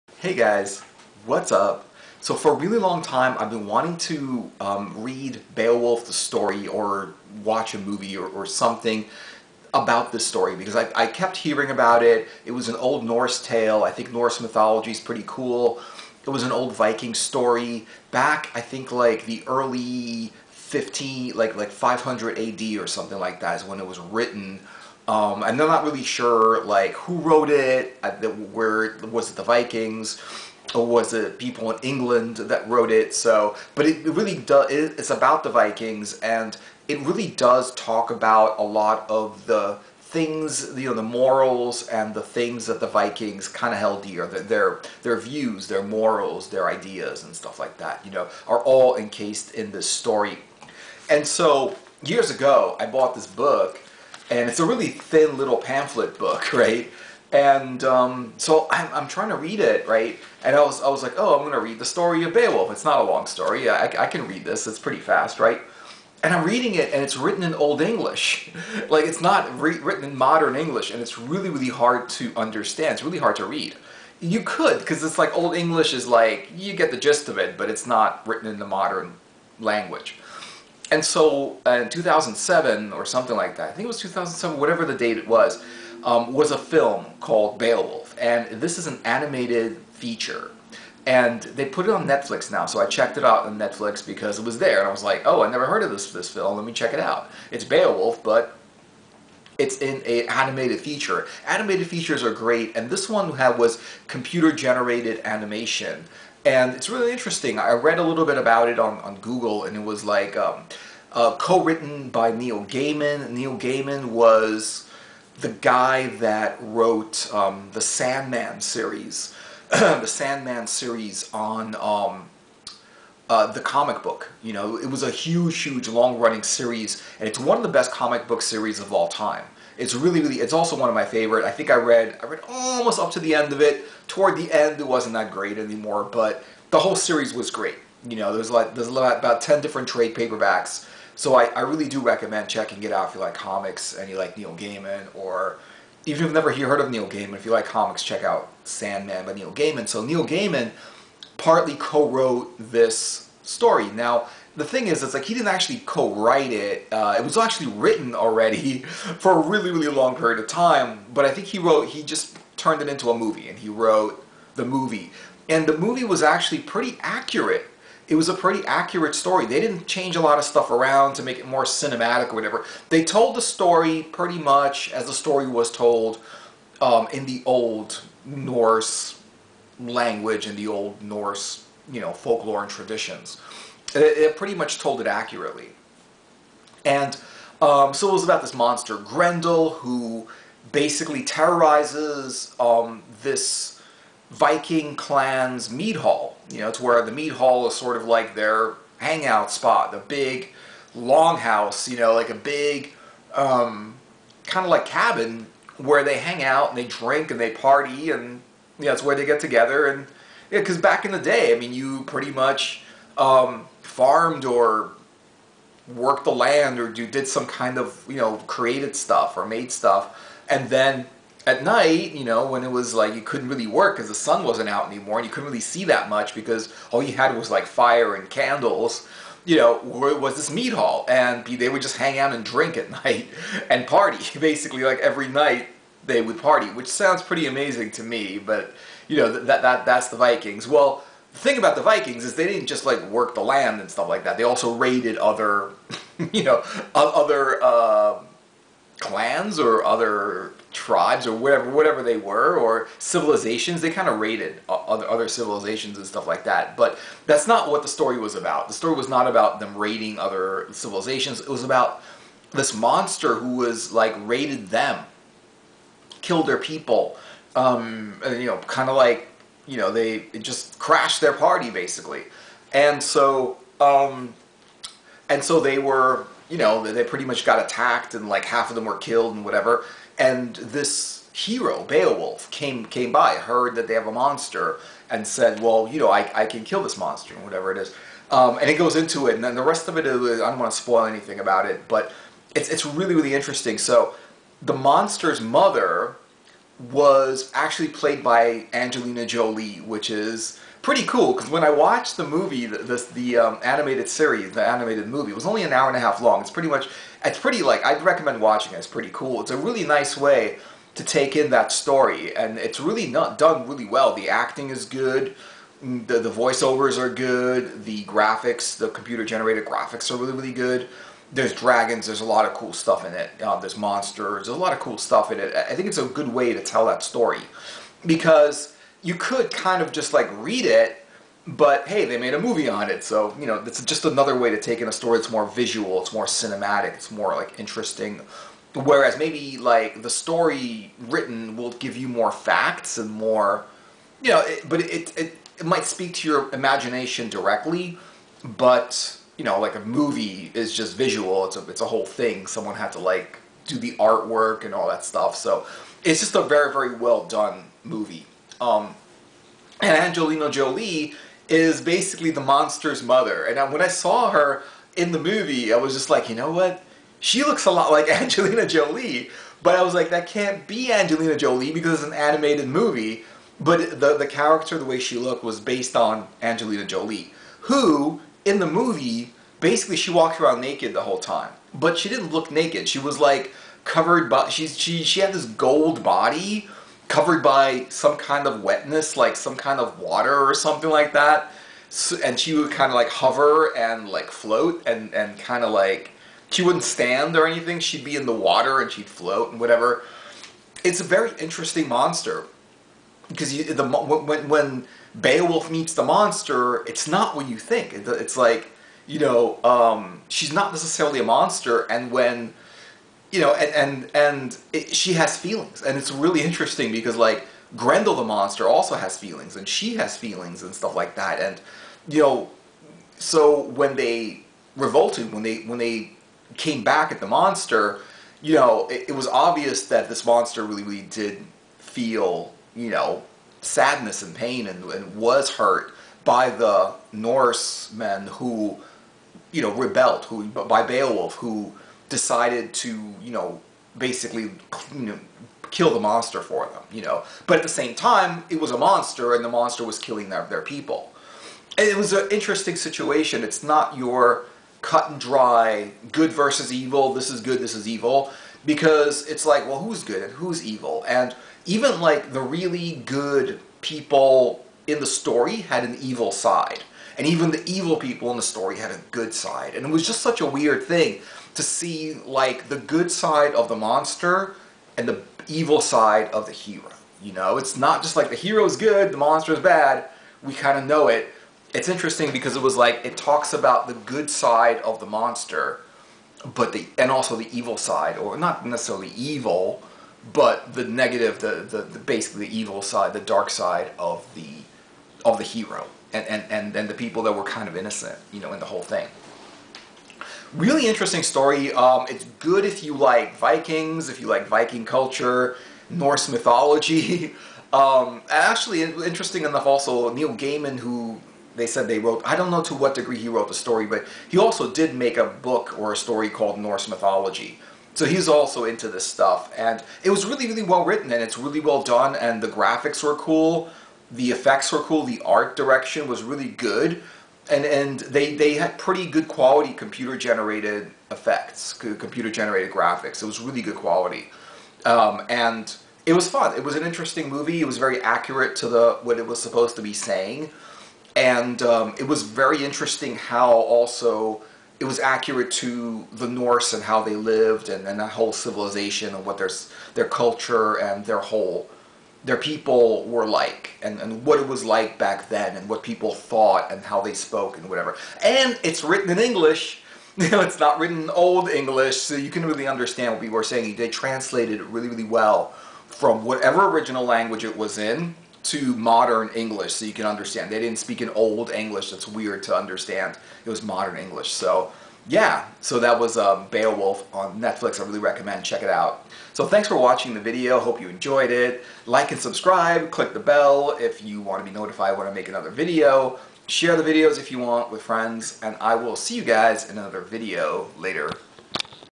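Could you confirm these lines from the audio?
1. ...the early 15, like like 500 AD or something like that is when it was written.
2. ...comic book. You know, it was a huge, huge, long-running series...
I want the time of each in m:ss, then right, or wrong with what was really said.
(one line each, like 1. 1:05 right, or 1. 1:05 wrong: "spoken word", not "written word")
1. 0:19 right
2. 2:03 right.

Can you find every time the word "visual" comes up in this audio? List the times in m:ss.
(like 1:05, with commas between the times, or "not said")
5:35, 5:50.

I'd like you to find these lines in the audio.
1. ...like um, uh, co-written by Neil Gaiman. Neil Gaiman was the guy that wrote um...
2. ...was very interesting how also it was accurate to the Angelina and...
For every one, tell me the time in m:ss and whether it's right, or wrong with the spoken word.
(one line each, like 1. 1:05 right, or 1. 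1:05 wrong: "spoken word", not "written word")
1. 1:50 right
2. 9:02 wrong: "Norse", not "Angelina".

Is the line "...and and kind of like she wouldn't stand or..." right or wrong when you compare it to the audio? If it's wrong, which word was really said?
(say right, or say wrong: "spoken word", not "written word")
right.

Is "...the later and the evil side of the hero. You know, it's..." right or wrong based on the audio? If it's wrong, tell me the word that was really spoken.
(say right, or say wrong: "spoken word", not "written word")
wrong: "monster", not "later".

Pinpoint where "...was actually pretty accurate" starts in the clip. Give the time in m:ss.
2:46.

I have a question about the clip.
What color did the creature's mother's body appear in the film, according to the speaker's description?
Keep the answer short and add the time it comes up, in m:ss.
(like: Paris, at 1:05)
gold, at 6:25.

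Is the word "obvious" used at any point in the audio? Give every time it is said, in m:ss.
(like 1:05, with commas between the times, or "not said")
7:09.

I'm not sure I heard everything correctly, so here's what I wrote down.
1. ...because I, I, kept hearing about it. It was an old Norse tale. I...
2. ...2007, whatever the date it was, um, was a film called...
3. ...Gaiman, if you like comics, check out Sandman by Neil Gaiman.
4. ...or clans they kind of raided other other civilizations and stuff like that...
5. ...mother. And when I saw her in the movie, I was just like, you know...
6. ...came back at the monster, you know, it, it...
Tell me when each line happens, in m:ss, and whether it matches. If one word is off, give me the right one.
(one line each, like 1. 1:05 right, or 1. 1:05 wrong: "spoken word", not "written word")
1. 0:10 right
2. 1:23 right
3. 2:27 right
4. 4:12 wrong: "civilizations", not "clans"
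5. 6:03 right
6. 7:06 right.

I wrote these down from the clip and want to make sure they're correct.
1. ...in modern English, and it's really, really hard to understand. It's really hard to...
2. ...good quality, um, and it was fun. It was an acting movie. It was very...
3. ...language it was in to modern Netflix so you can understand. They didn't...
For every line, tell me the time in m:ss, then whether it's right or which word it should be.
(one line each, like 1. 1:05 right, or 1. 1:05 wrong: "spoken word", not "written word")
1. 1:10 right
2. 8:53 wrong: "interesting", not "acting"
3. 9:27 wrong: "English", not "Netflix".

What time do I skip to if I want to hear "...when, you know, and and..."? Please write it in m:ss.
6:52.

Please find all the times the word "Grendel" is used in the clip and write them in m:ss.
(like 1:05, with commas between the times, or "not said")
3:08, 6:57.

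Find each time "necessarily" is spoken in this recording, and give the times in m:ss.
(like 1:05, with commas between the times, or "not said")
6:50, 8:08.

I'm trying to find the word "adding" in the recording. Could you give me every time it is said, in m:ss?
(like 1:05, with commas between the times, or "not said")
not said.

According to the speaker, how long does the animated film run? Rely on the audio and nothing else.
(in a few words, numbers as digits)
an hour and a half.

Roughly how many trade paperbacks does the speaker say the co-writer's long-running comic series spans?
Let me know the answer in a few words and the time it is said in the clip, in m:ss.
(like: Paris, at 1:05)
10, at 2:18.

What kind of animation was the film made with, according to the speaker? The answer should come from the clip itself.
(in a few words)
computer-generated animation.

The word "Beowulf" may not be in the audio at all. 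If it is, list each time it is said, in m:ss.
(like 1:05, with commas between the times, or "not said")
0:05, 1:02, 1:27, 1:37, 4:41, 6:45, 7:20, 9:36.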